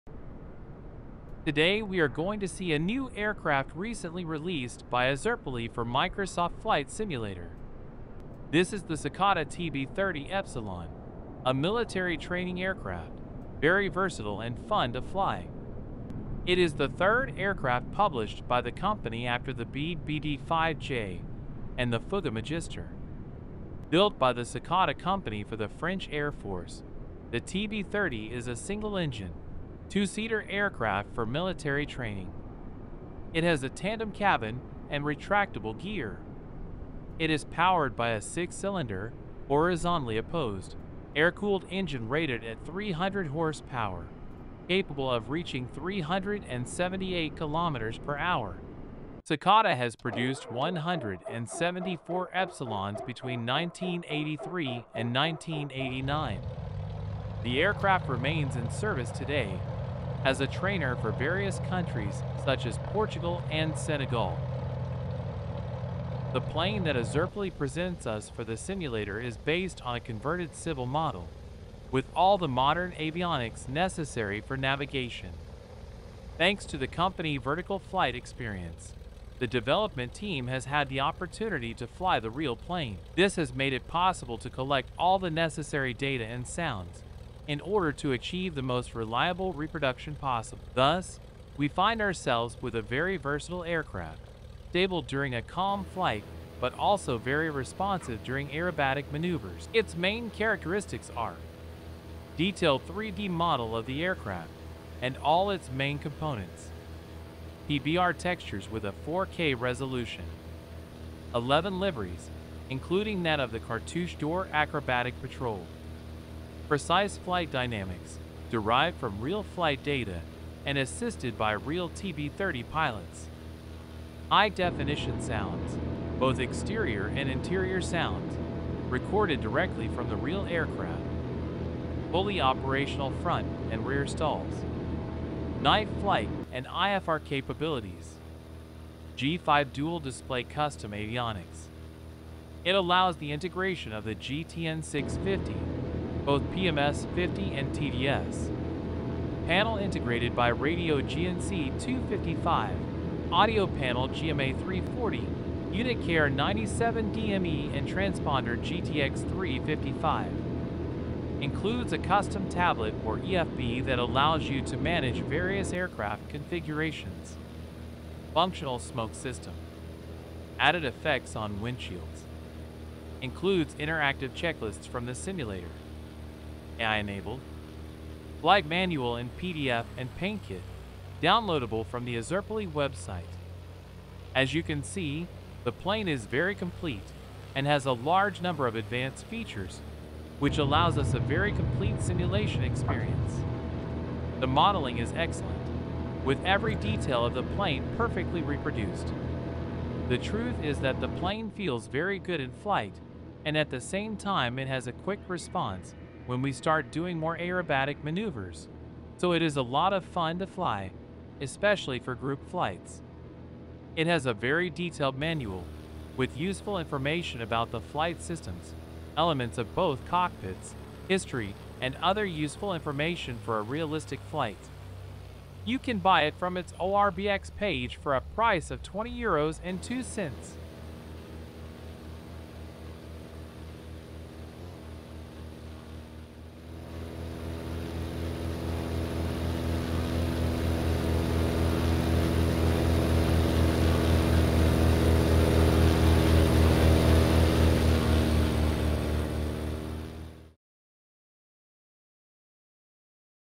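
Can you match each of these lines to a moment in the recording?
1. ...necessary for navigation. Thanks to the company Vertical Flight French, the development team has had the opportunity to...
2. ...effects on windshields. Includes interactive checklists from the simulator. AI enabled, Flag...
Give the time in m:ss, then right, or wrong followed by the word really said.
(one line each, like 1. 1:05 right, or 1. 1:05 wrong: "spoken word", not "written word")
1. 1:13 wrong: "Experience", not "French"
2. 2:50 right.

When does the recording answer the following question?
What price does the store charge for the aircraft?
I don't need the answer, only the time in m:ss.
3:48.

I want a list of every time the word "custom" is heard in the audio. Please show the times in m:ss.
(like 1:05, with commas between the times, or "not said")
2:20, 2:41.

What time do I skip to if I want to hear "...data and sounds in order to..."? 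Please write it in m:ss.
1:25.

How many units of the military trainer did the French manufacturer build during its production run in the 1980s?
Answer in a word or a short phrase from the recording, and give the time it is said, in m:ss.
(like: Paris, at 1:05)
174, at 0:50.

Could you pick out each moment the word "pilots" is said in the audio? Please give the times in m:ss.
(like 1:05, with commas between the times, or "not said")
2:02.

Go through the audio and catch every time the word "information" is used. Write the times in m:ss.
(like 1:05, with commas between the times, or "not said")
3:36, 3:42.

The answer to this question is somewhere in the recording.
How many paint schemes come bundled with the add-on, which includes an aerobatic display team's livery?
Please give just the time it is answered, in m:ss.
1:51.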